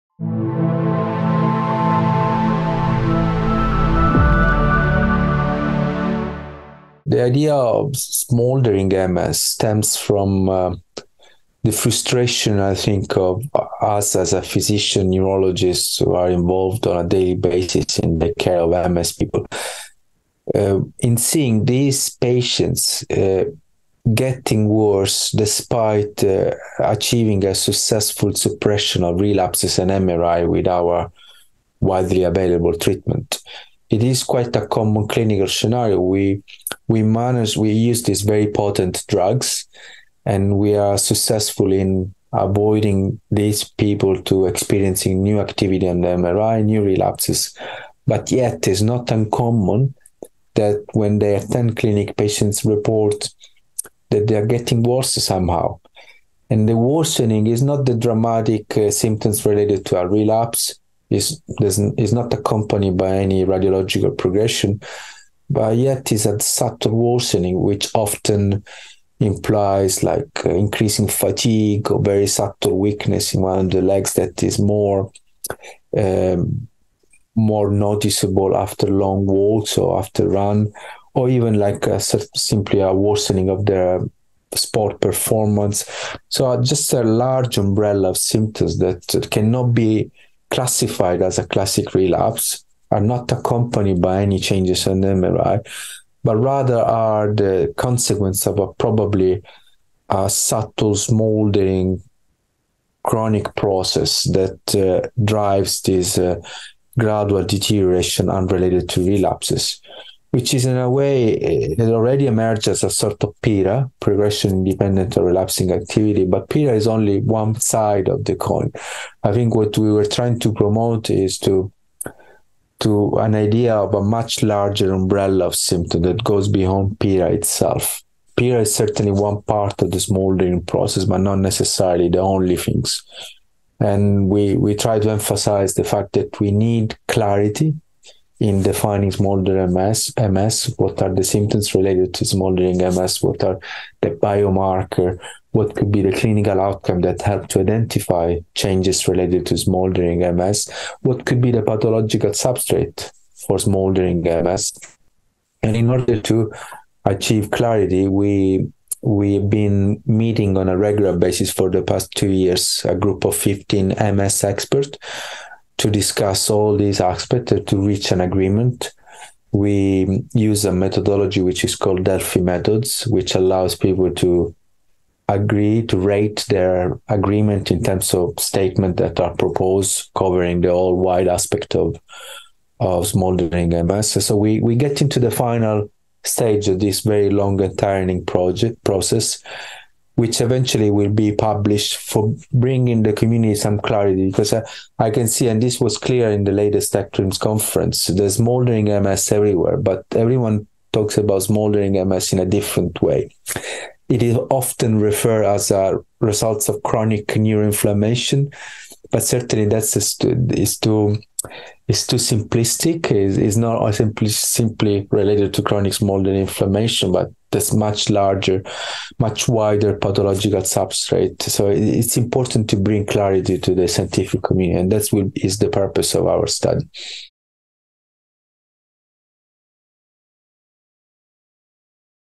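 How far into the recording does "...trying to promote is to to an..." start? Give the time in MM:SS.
02:00.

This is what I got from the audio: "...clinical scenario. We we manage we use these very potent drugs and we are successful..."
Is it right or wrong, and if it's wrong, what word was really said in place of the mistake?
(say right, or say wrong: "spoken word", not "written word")
right.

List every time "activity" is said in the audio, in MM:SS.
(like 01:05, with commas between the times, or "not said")
00:45, 01:55.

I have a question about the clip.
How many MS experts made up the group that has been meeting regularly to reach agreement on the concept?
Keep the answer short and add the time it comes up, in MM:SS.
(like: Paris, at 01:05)
15, at 02:43.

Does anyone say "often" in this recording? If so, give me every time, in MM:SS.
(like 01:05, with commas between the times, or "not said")
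01:07, 03:24.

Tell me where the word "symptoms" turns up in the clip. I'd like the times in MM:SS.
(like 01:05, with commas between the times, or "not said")
00:58, 01:28, 02:05, 02:21.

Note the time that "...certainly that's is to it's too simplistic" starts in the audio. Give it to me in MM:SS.
03:29.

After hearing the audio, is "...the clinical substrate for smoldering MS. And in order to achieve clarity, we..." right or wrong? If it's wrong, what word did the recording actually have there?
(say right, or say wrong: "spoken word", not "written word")
wrong: "pathological", not "clinical".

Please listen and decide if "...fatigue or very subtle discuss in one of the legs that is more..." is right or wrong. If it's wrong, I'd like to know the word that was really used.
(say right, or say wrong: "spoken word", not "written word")
wrong: "weakness", not "discuss".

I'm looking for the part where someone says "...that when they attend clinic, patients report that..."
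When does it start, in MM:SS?
00:50.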